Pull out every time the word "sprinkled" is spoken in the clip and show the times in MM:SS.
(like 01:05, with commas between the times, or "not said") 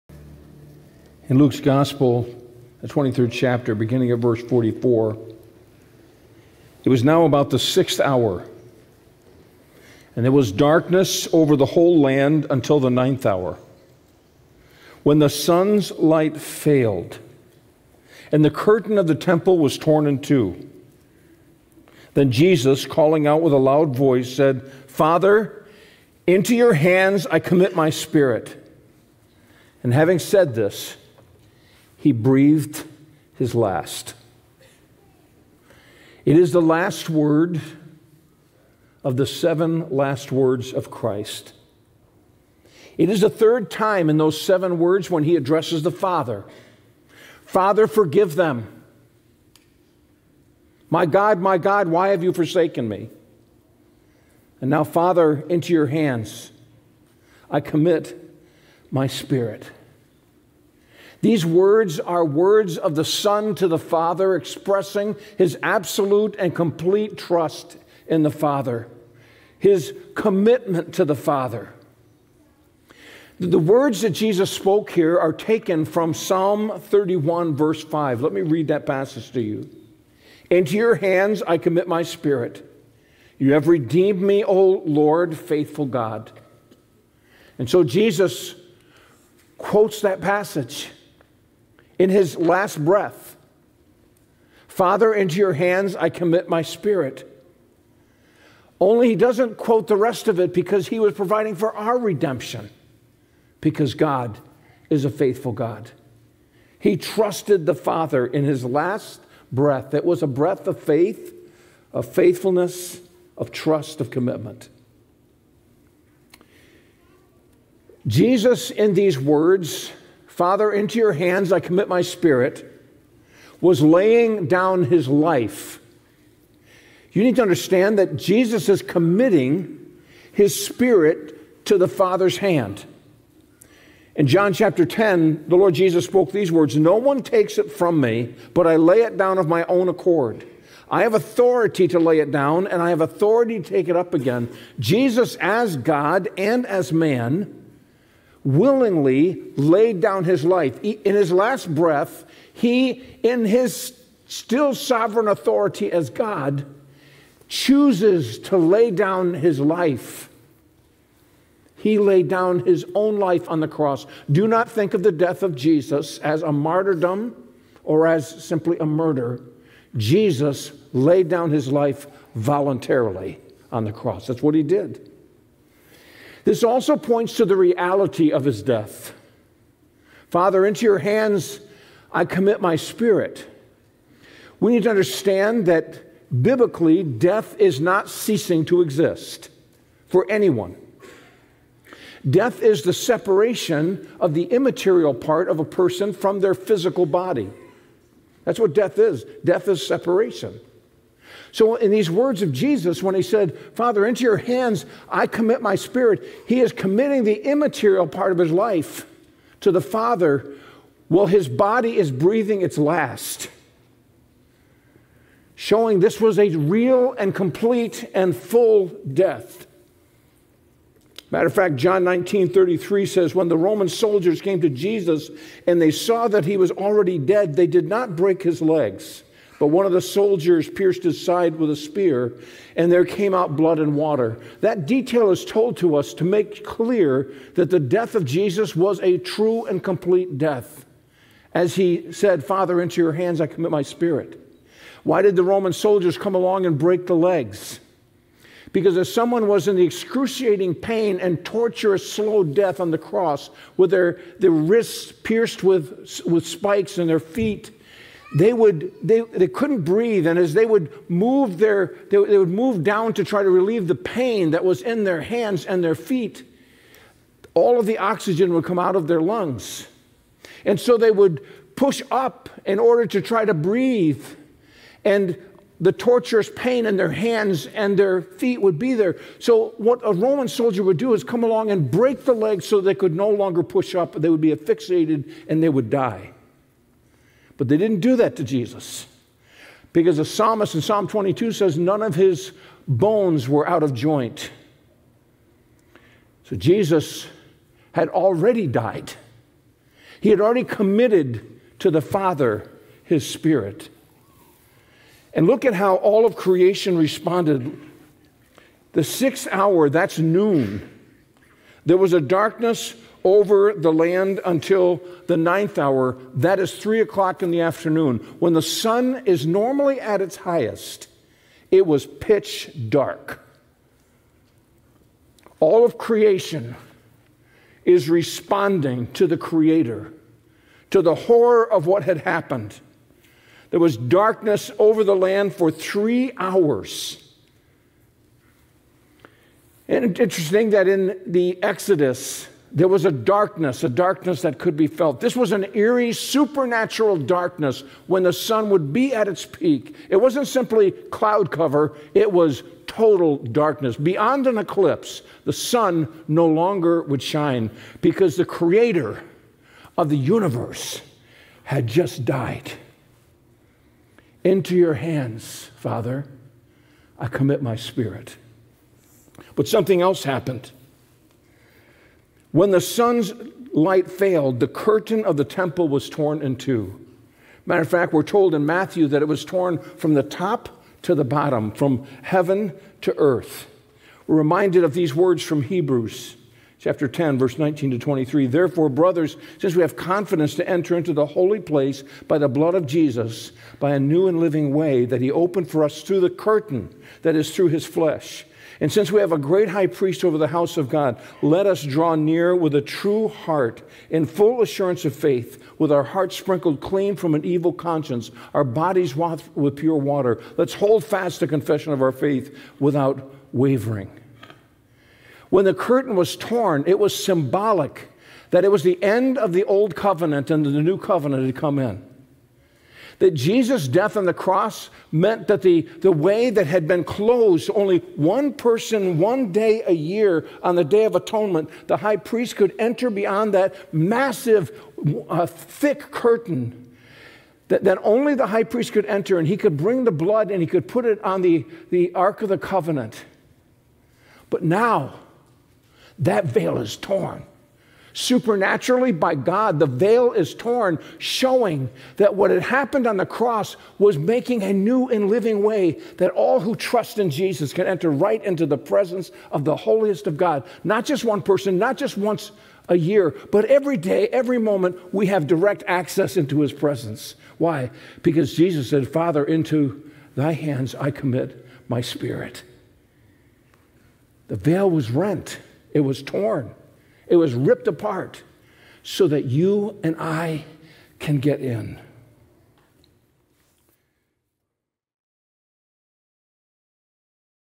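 06:46.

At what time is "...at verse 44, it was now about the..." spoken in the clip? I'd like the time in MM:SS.
00:04.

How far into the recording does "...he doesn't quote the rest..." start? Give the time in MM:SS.
01:39.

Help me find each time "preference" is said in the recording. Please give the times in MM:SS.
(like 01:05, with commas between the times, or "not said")
not said.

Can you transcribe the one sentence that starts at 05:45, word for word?
This was an eerie, supernatural darkness when the sun would be at its peak.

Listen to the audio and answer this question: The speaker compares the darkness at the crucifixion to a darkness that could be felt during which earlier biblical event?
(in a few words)
The Exodus.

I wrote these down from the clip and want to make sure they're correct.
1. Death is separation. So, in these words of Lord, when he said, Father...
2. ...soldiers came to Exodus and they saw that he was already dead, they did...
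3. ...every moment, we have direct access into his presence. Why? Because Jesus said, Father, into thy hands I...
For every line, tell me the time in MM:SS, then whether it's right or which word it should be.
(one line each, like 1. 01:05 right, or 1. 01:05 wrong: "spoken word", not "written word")
1. 03:19 wrong: "Jesus", not "Lord"
2. 03:43 wrong: "Jesus", not "Exodus"
3. 07:44 right.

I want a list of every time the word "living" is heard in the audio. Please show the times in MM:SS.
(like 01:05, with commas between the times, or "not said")
06:34, 07:35.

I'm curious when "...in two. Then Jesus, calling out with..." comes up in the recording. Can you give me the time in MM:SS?
00:20.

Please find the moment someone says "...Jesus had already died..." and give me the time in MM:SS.
04:56.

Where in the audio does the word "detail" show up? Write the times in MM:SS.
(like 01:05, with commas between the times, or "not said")
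03:54.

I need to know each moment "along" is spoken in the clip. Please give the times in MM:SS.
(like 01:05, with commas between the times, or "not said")
04:06, 04:41.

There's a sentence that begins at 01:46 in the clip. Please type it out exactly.
He trusted the Father in his last breath.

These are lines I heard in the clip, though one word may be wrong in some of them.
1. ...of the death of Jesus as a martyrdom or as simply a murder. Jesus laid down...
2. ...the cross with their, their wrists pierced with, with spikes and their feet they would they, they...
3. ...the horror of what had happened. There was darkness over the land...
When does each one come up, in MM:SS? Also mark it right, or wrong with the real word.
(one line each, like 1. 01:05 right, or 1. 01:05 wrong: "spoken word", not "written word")
1. 02:44 right
2. 04:12 right
3. 05:31 right.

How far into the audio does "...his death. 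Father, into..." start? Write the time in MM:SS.
02:58.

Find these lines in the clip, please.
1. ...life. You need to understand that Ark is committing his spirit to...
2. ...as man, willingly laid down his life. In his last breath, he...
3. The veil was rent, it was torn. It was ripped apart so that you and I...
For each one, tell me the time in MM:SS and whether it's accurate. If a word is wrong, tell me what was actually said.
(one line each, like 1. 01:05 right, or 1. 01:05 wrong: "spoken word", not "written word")
1. 02:05 wrong: "Jesus", not "Ark"
2. 02:26 right
3. 07:54 right.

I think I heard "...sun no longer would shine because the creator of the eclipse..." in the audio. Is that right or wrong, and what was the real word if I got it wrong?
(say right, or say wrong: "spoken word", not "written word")
wrong: "universe", not "eclipse".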